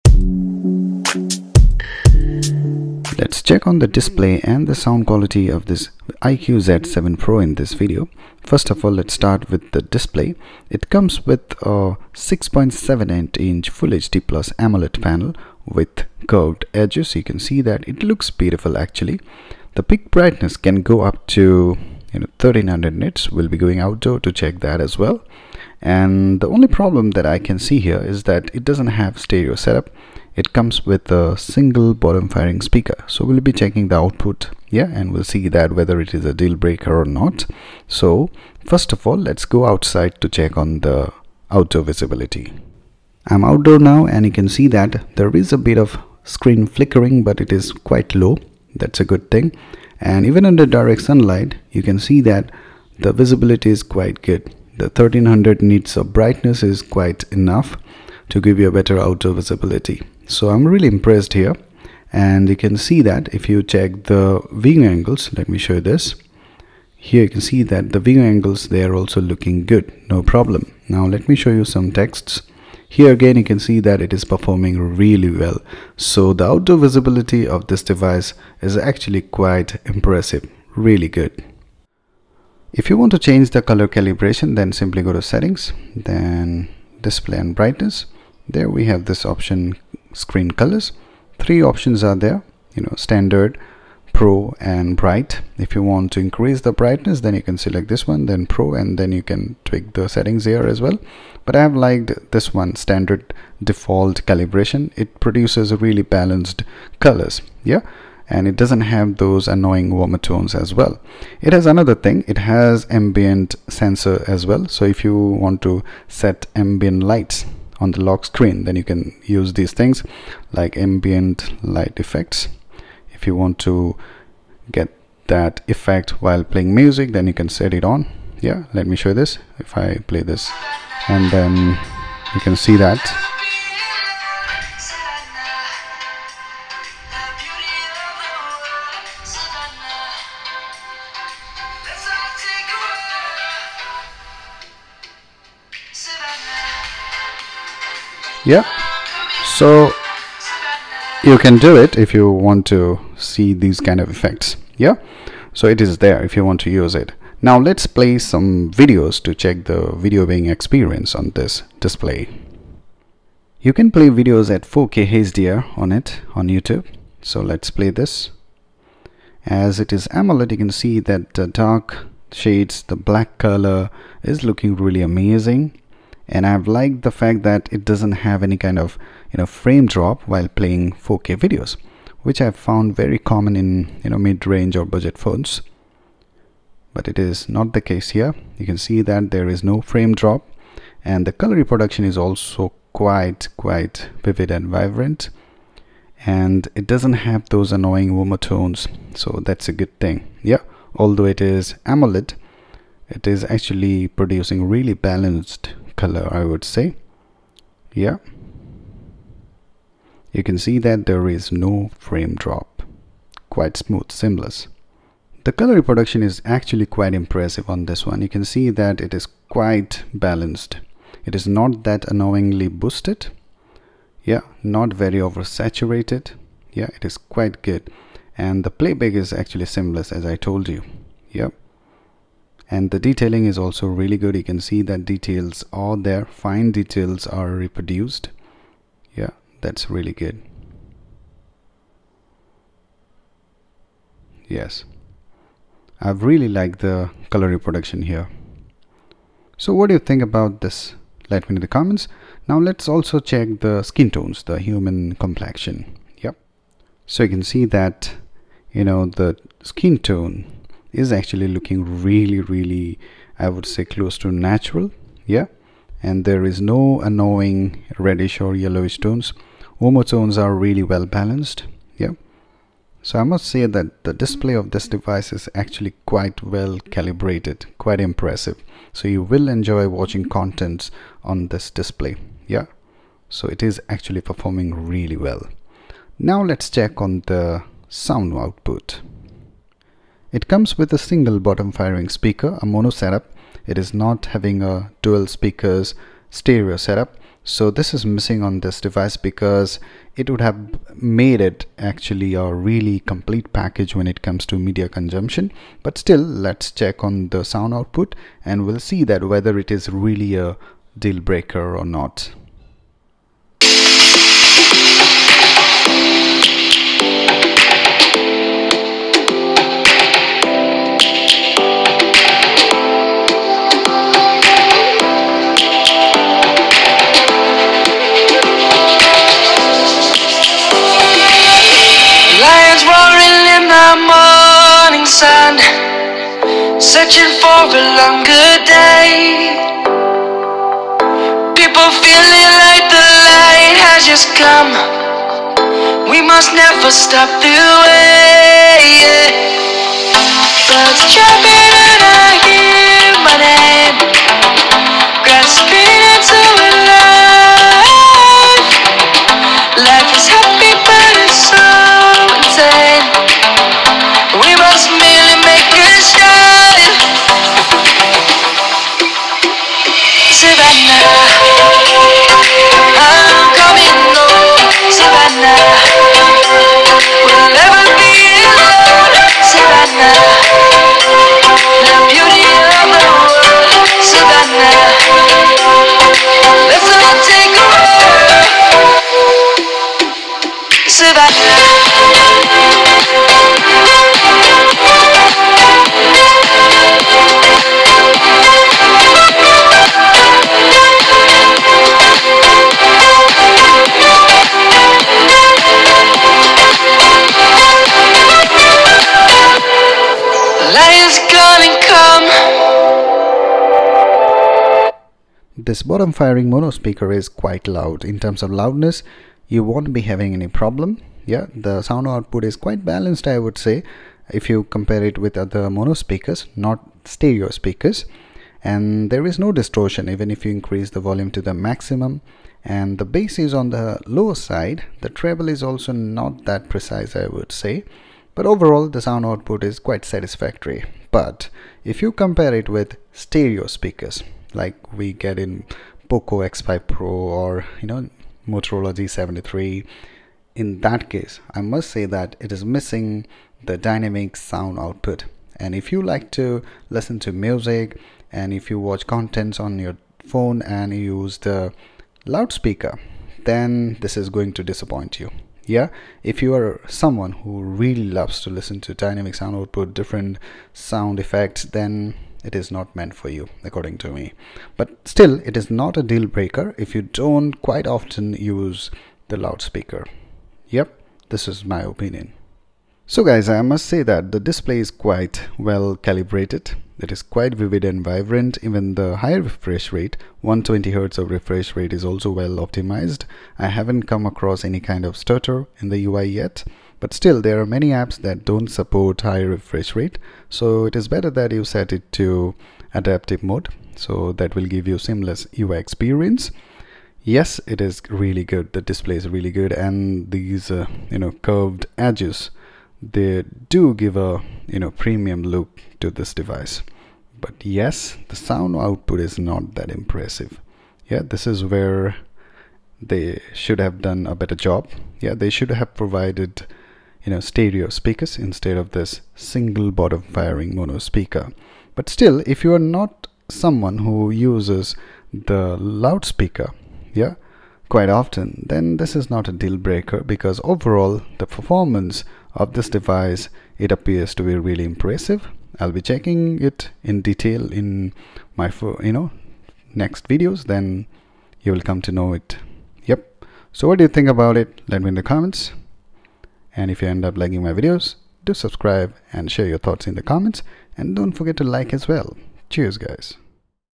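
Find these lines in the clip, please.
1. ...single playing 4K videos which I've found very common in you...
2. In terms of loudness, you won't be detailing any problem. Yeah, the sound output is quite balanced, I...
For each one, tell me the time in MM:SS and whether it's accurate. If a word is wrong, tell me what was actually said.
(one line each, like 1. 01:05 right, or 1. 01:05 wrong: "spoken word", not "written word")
1. 03:00 wrong: "while", not "single"
2. 06:58 wrong: "having", not "detailing".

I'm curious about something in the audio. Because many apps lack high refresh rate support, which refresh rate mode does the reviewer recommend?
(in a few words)
adaptive mode.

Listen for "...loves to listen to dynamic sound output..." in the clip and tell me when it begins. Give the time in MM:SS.
07:48.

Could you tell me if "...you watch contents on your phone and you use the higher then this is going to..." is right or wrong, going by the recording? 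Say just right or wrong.
wrong.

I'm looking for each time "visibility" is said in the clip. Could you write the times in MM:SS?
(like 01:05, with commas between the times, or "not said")
00:41, 00:53, 00:59, 01:16.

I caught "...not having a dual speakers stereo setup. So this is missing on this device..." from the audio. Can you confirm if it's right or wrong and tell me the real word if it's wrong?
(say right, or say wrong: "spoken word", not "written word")
right.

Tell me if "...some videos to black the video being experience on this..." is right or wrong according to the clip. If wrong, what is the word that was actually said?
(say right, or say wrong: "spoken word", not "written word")
wrong: "check", not "black".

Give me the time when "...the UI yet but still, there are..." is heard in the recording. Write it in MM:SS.
08:15.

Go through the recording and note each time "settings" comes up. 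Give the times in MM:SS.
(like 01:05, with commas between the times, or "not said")
01:25, 01:40.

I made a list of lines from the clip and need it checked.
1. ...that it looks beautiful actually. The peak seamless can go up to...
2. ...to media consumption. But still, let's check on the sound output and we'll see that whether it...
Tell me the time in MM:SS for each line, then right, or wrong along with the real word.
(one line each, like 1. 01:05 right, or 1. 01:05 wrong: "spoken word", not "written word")
1. 00:17 wrong: "brightness", not "seamless"
2. 05:04 right.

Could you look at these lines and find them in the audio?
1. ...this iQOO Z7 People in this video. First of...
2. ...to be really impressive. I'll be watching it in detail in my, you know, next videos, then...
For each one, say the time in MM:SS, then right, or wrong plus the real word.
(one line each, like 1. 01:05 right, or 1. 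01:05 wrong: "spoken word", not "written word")
1. 00:05 wrong: "Pro", not "People"
2. 09:04 wrong: "checking", not "watching".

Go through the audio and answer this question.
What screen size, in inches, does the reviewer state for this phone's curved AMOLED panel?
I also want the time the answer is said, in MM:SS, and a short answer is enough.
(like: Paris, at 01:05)
6.78 inch, at 00:12.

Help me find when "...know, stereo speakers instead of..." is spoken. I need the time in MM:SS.
08:47.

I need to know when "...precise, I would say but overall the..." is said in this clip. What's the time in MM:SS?
07:16.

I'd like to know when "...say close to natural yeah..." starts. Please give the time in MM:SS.
04:23.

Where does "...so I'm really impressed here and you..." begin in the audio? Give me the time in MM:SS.
01:00.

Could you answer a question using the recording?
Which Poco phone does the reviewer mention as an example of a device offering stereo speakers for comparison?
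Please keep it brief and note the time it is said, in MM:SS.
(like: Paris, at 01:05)
Poco X5 Pro, at 07:26.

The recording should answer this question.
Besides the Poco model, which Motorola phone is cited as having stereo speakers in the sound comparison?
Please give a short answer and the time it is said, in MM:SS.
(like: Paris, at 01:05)
Motorola G73, at 07:28.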